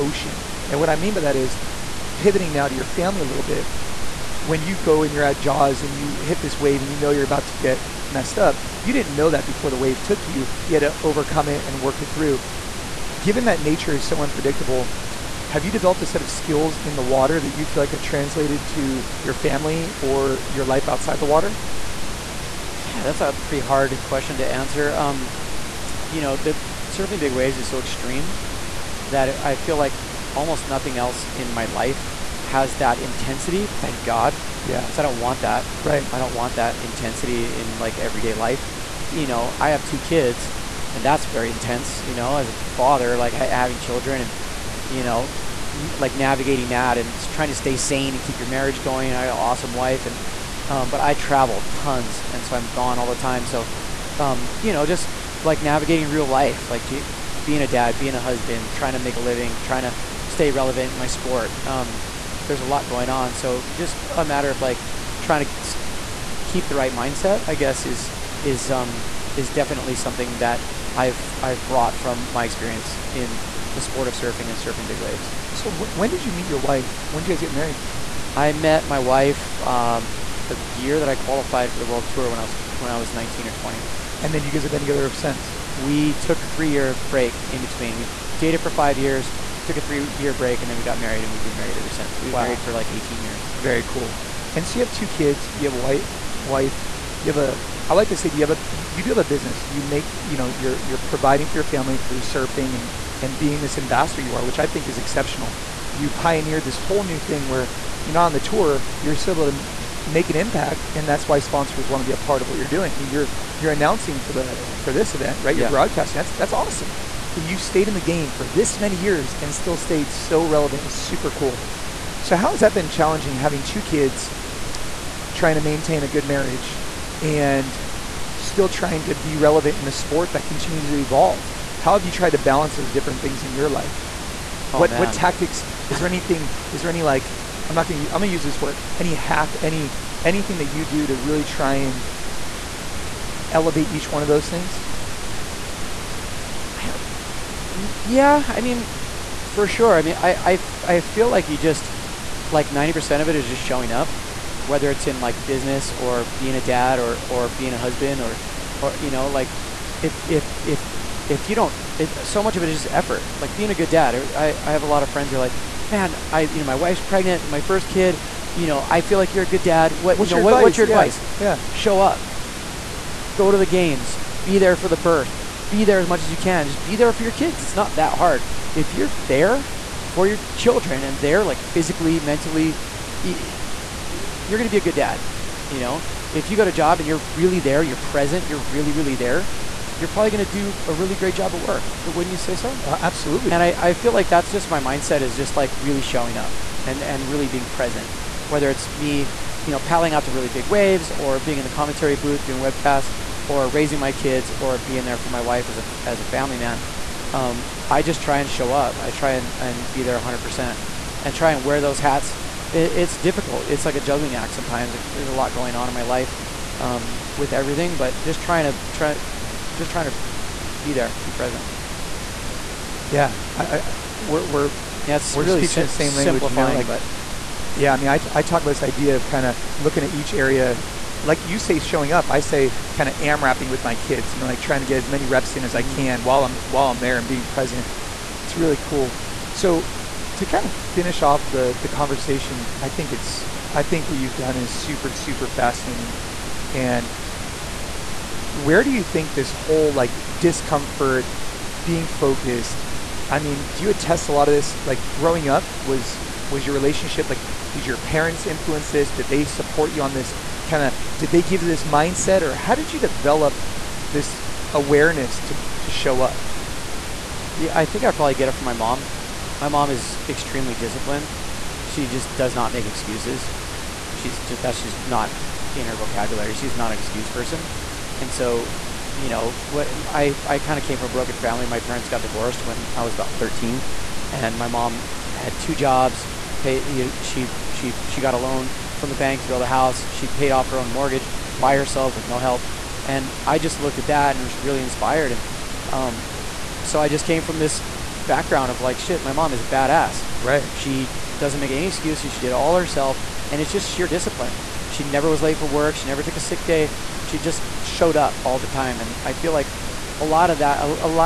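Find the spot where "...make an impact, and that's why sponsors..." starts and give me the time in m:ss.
1:50.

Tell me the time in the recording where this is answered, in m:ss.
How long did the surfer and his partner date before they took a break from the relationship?
1:28.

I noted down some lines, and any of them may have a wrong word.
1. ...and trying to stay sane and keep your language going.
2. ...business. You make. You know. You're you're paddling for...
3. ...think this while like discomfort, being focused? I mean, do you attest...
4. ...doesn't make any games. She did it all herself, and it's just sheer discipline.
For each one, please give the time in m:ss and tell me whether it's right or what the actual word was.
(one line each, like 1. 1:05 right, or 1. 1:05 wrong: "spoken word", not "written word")
1. 0:46 wrong: "marriage", not "language"
2. 1:39 wrong: "providing", not "paddling"
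3. 4:09 wrong: "whole", not "while"
4. 5:01 wrong: "excuses", not "games".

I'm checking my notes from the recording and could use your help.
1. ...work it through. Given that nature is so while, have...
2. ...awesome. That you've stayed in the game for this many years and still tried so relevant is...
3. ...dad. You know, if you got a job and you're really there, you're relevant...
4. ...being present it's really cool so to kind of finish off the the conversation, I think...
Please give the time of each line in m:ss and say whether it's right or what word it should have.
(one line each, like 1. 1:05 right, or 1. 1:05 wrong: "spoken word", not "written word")
1. 0:11 wrong: "unpredictable", not "while"
2. 1:56 wrong: "stayed", not "tried"
3. 3:04 wrong: "present", not "relevant"
4. 3:57 right.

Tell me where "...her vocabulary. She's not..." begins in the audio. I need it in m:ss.
4:35.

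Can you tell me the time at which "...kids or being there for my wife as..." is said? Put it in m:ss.
3:24.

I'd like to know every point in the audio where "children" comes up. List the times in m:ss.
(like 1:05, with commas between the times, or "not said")
0:43, 3:00.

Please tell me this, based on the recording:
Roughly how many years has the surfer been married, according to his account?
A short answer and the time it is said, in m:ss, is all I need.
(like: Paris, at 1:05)
18 years, at 1:32.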